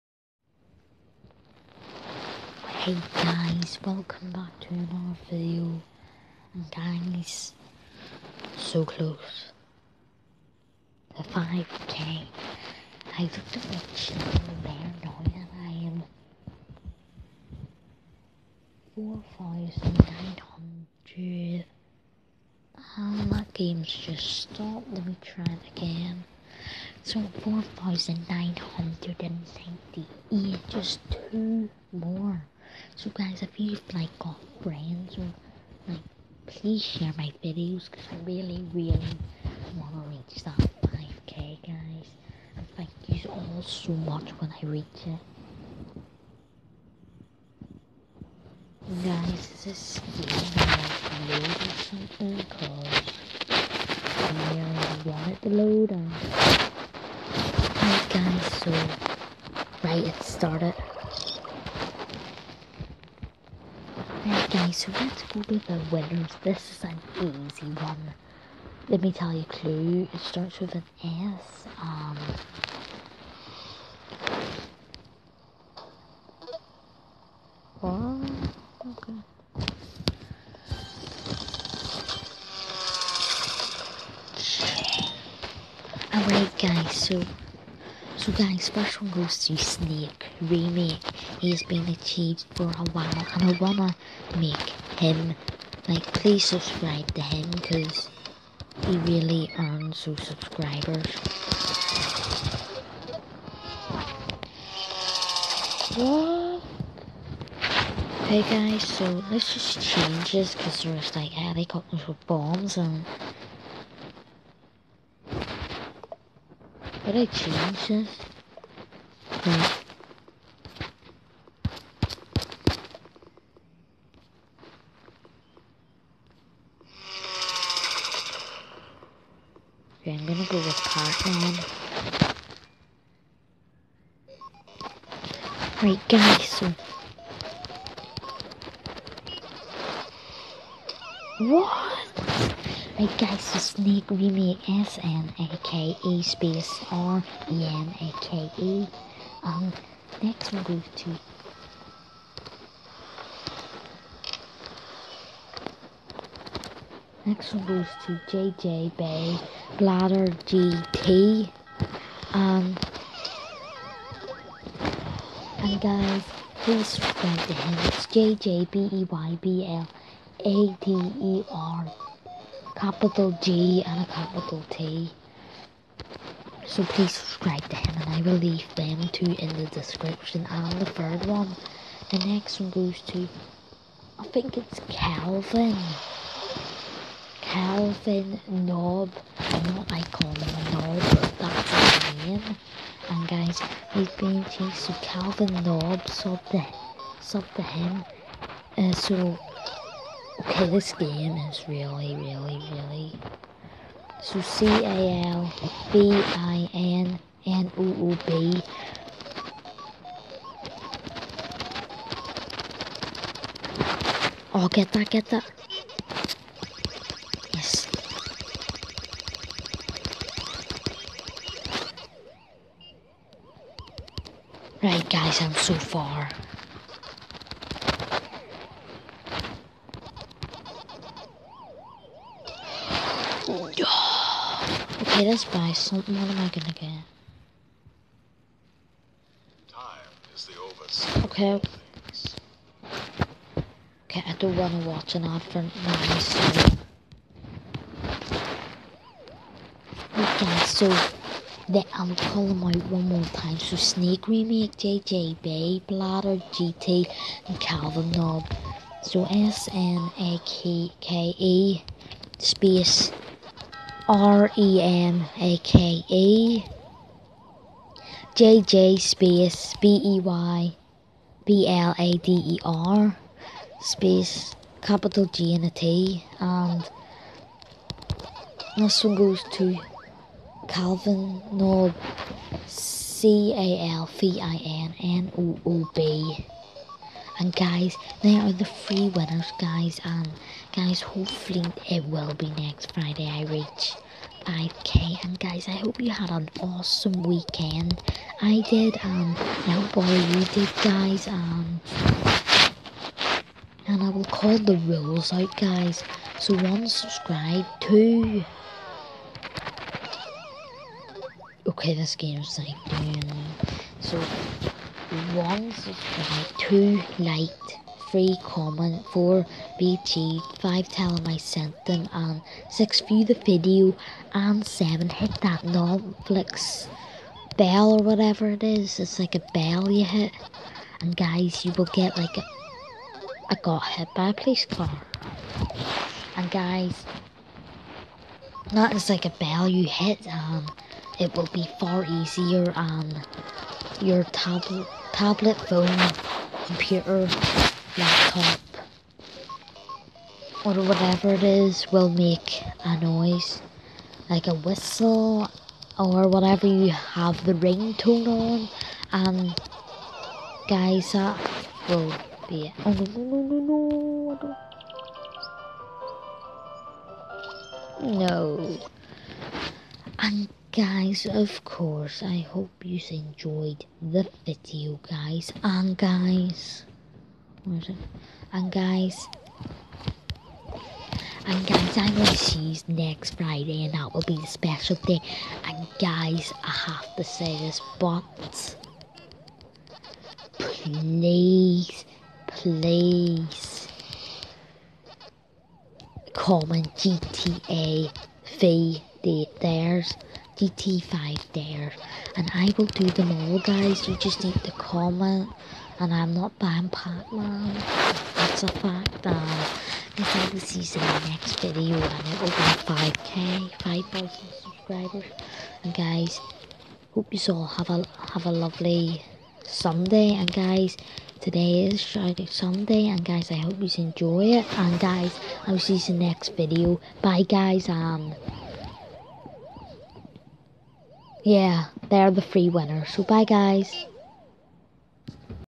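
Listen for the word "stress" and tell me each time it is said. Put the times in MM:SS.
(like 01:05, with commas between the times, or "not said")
not said.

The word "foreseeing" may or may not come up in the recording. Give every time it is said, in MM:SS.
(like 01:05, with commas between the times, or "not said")
not said.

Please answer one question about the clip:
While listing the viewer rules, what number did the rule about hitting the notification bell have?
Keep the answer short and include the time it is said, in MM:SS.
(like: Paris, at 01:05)
7, at 05:24.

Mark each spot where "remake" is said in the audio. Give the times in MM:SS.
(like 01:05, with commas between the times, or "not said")
01:30, 04:14.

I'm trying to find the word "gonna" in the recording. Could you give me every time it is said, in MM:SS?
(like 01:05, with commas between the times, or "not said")
02:10, 03:56.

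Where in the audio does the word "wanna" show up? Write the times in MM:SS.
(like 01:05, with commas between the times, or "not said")
01:33, 04:04.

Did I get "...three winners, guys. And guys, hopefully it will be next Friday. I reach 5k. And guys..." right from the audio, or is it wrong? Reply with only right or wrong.
right.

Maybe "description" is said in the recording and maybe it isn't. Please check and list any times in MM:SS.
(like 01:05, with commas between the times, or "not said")
02:59.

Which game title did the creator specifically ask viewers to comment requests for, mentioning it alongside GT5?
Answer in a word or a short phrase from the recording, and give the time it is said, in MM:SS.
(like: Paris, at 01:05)
GTA V, at 06:37.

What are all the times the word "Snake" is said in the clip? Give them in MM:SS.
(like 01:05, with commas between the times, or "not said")
01:29, 02:23, 04:13.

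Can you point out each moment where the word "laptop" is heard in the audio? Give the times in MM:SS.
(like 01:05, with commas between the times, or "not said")
05:47.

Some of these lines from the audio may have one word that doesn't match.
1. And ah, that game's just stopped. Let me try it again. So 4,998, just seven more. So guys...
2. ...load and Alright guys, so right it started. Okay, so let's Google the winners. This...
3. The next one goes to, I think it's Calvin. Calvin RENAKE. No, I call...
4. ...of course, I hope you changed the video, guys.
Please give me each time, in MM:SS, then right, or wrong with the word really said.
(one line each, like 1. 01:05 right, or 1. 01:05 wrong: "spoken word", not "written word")
1. 00:21 wrong: "two", not "seven"
2. 00:55 right
3. 03:02 wrong: "Noob", not "RENAKE"
4. 06:11 wrong: "enjoyed", not "changed".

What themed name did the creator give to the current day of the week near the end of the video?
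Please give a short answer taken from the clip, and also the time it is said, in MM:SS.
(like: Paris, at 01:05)
Shark Sunday, at 07:01.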